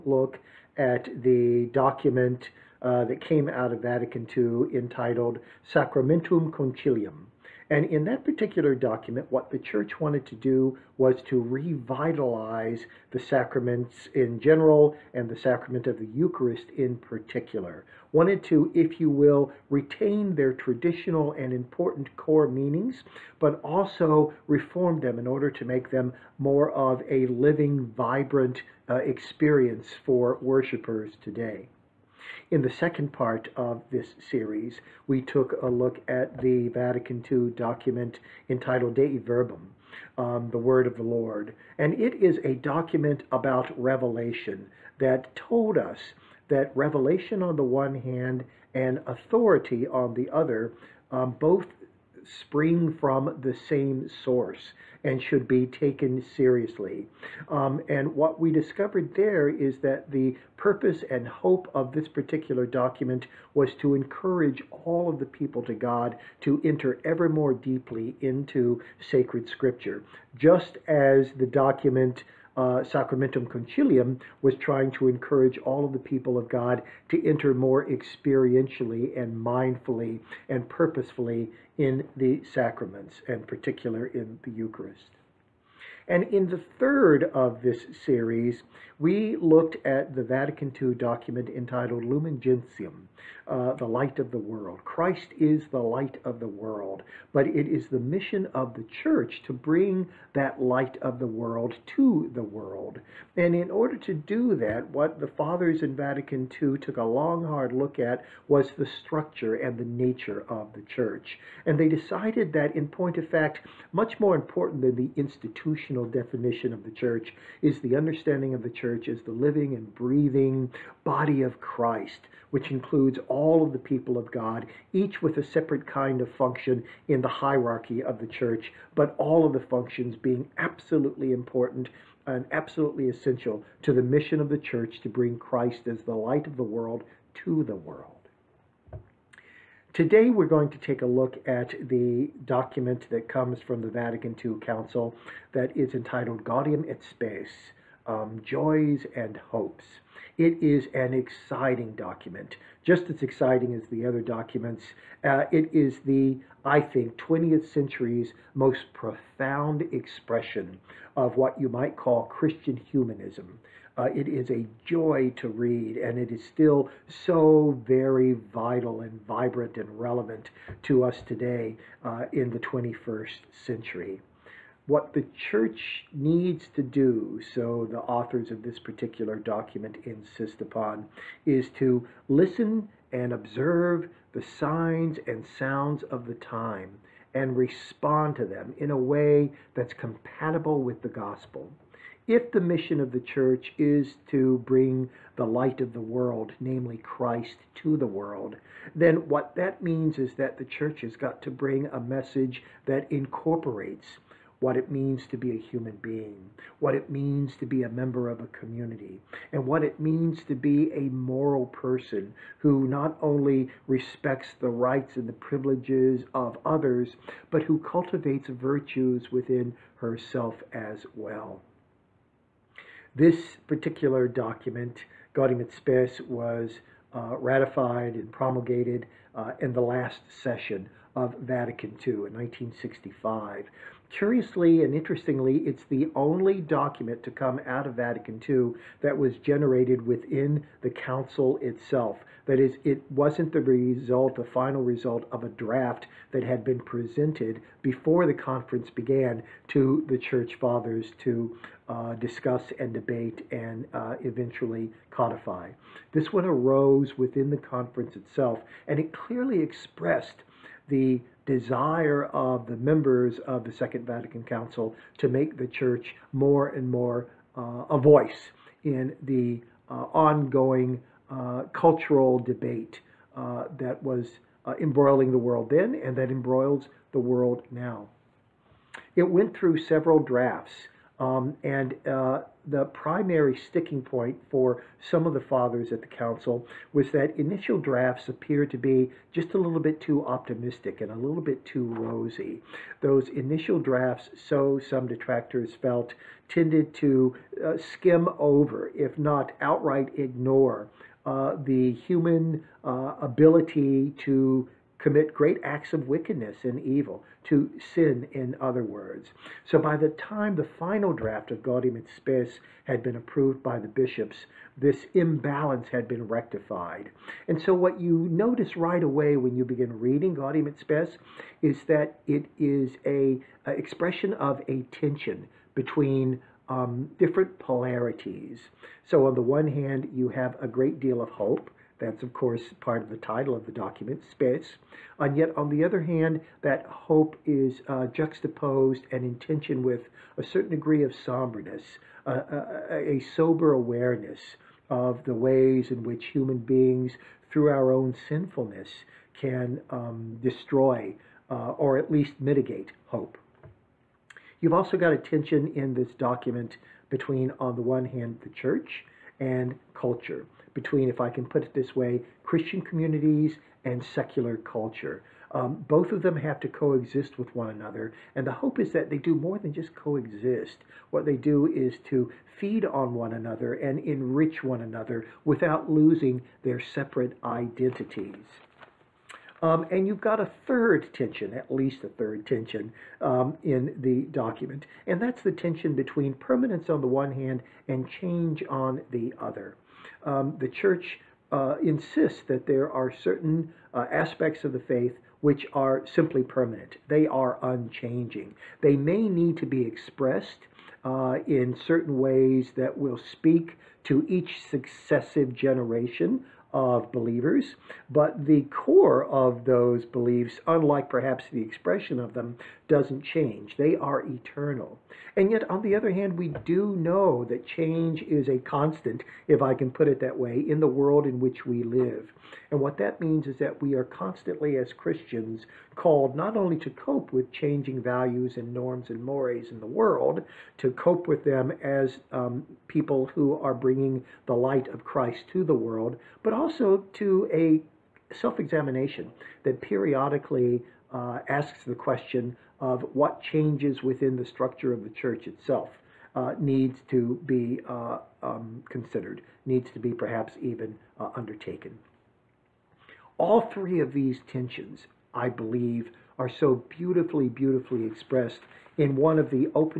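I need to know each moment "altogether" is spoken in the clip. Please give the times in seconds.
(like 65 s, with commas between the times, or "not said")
not said.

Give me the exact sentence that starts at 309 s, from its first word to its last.
So by the time the final draft of Gaudium et Spes had been approved by the bishops, this imbalance had been rectified.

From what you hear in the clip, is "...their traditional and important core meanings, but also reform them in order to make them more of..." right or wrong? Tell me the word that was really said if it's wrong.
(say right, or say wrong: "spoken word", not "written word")
right.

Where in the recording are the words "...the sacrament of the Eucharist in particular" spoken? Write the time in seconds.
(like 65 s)
15 s.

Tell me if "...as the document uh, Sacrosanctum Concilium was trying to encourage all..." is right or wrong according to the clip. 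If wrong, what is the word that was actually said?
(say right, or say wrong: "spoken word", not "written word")
right.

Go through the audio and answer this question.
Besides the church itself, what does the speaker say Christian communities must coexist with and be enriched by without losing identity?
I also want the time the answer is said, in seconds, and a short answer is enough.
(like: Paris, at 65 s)
secular culture, at 364 s.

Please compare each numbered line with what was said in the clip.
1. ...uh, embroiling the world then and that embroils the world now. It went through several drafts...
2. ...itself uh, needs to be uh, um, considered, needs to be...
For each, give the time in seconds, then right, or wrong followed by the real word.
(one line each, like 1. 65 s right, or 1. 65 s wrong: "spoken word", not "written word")
1. 274 s right
2. 445 s right.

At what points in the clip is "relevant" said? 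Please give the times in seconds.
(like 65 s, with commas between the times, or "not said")
170 s.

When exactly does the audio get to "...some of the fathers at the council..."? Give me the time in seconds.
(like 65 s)
285 s.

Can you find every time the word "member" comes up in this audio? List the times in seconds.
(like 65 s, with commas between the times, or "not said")
207 s, 262 s.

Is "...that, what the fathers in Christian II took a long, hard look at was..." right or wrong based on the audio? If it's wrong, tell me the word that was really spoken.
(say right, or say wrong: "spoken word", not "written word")
wrong: "Vatican", not "Christian".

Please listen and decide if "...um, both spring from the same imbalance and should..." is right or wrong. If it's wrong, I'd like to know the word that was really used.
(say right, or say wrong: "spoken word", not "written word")
wrong: "source", not "imbalance".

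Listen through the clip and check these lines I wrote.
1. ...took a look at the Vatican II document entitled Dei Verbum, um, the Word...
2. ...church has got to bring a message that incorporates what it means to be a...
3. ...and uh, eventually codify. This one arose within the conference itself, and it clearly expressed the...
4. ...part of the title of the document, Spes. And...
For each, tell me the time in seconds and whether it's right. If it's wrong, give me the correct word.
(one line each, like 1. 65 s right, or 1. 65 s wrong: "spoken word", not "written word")
1. 35 s right
2. 200 s right
3. 253 s right
4. 332 s right.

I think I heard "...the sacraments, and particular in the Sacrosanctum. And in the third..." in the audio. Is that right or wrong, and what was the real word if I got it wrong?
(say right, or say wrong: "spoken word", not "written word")
wrong: "Eucharist", not "Sacrosanctum".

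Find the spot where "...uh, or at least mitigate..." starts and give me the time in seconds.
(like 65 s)
351 s.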